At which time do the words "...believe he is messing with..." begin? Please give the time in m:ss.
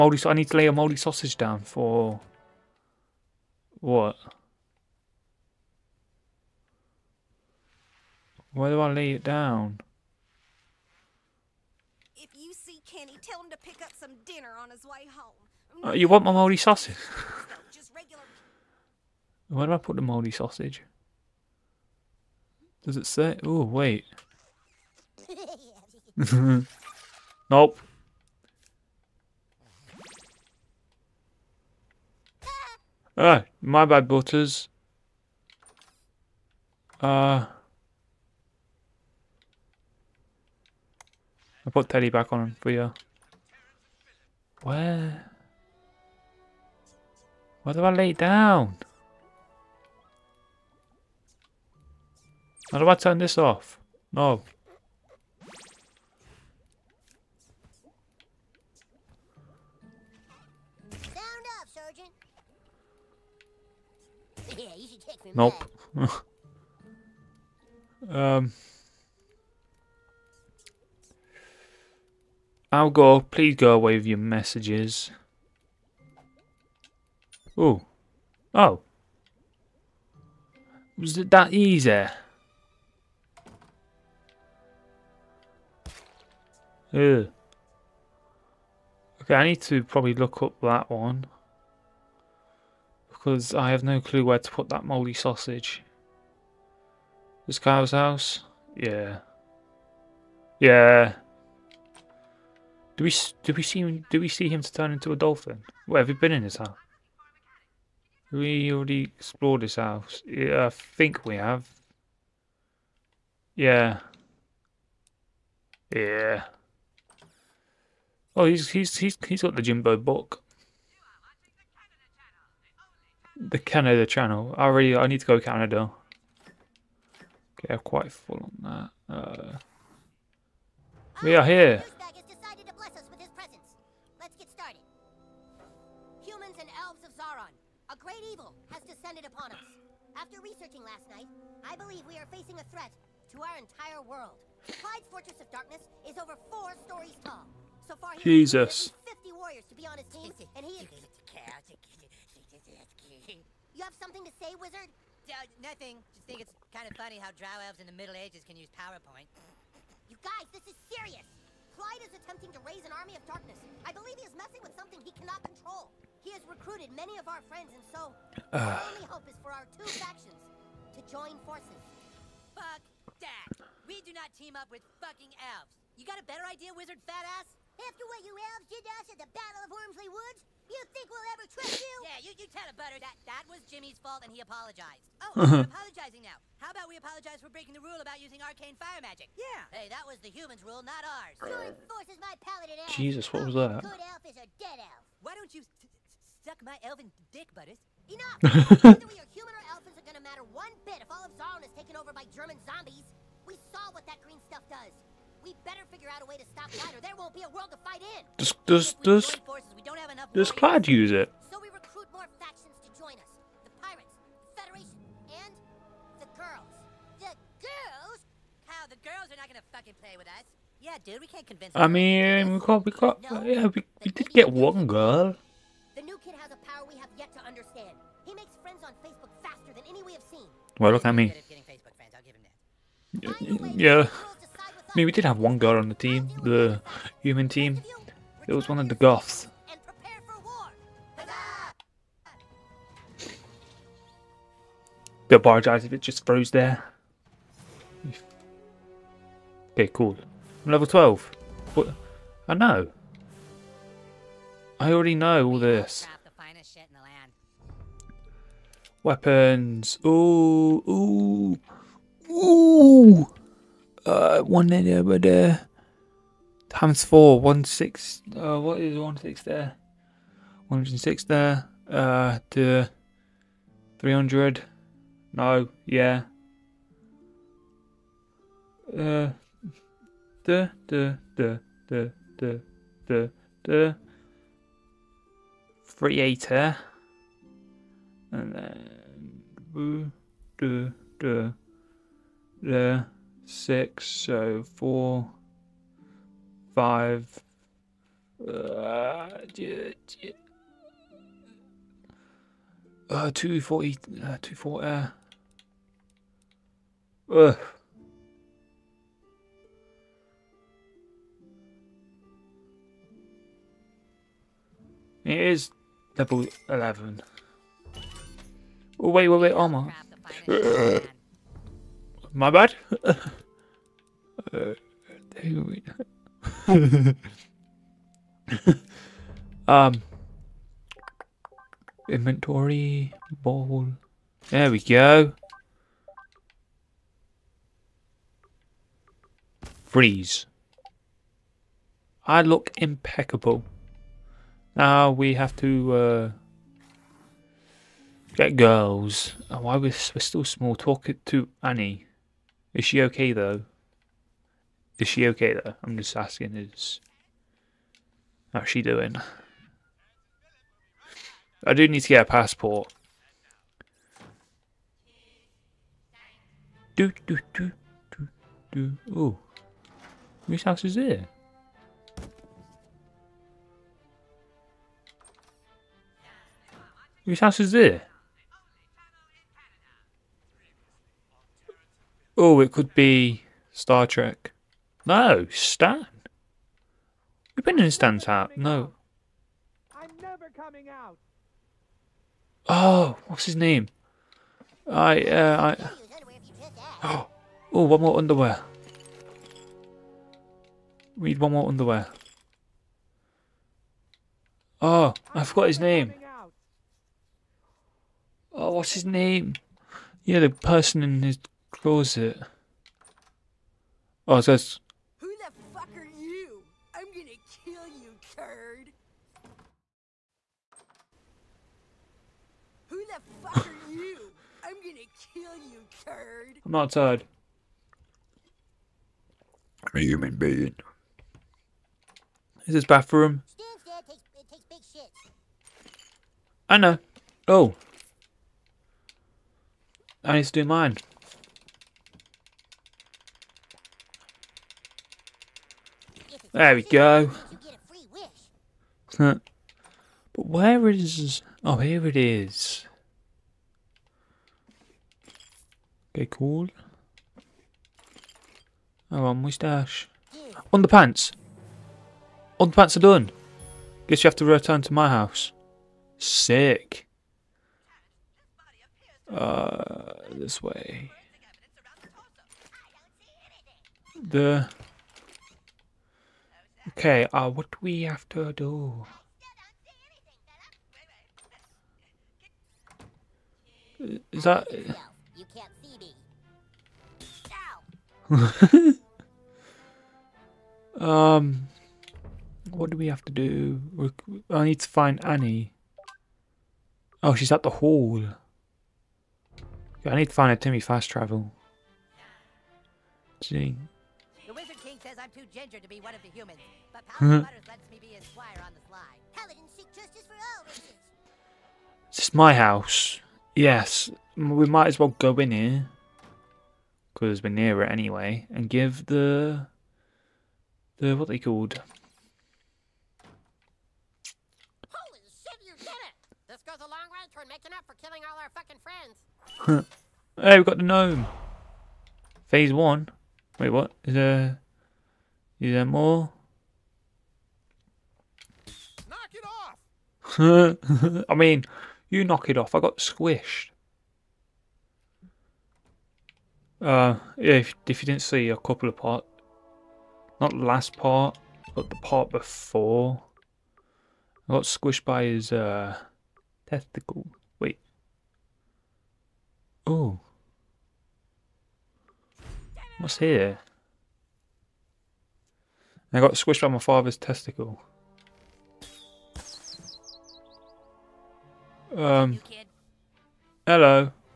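2:43.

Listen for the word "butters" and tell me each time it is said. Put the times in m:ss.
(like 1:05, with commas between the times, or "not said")
0:34, 3:02, 3:17.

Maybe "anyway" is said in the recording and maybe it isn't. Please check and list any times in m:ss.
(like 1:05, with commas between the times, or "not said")
8:37.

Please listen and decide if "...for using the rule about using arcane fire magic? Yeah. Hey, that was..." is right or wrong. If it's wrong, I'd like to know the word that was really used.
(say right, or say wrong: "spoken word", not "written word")
wrong: "breaking", not "using".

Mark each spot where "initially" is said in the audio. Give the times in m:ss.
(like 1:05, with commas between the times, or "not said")
not said.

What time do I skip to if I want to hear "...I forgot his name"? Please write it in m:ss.
6:45.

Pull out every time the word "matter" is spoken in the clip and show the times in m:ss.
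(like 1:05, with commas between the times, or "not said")
3:20.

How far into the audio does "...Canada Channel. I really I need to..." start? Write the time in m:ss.
2:03.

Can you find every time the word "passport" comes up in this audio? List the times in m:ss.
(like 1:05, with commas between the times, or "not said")
6:02.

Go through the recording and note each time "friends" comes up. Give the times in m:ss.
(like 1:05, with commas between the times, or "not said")
2:47, 8:49.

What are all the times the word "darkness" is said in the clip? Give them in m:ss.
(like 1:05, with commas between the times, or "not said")
2:25, 2:43.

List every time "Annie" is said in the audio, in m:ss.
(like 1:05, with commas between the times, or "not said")
5:51, 8:15.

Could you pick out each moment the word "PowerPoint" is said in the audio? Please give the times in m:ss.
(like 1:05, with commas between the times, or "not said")
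2:38.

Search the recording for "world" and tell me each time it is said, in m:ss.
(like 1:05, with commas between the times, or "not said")
2:23, 3:27.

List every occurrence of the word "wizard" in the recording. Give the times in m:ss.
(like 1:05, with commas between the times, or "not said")
2:34, 2:56.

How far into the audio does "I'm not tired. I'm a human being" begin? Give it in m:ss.
7:06.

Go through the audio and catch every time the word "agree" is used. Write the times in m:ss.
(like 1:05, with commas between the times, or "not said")
not said.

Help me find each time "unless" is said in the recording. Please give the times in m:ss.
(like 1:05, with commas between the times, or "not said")
not said.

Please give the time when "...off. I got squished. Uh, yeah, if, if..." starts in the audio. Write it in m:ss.
9:02.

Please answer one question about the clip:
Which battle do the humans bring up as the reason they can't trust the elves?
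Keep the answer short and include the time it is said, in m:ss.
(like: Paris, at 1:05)
Battle of Wormsley Woods, at 2:59.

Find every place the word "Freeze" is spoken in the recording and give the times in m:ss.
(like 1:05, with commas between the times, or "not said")
5:39.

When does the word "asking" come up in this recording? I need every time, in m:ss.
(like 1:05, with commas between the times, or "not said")
5:56.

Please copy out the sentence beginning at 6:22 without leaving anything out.
Oh, it could be Star Trek.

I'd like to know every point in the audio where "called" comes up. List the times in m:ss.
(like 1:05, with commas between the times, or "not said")
8:41.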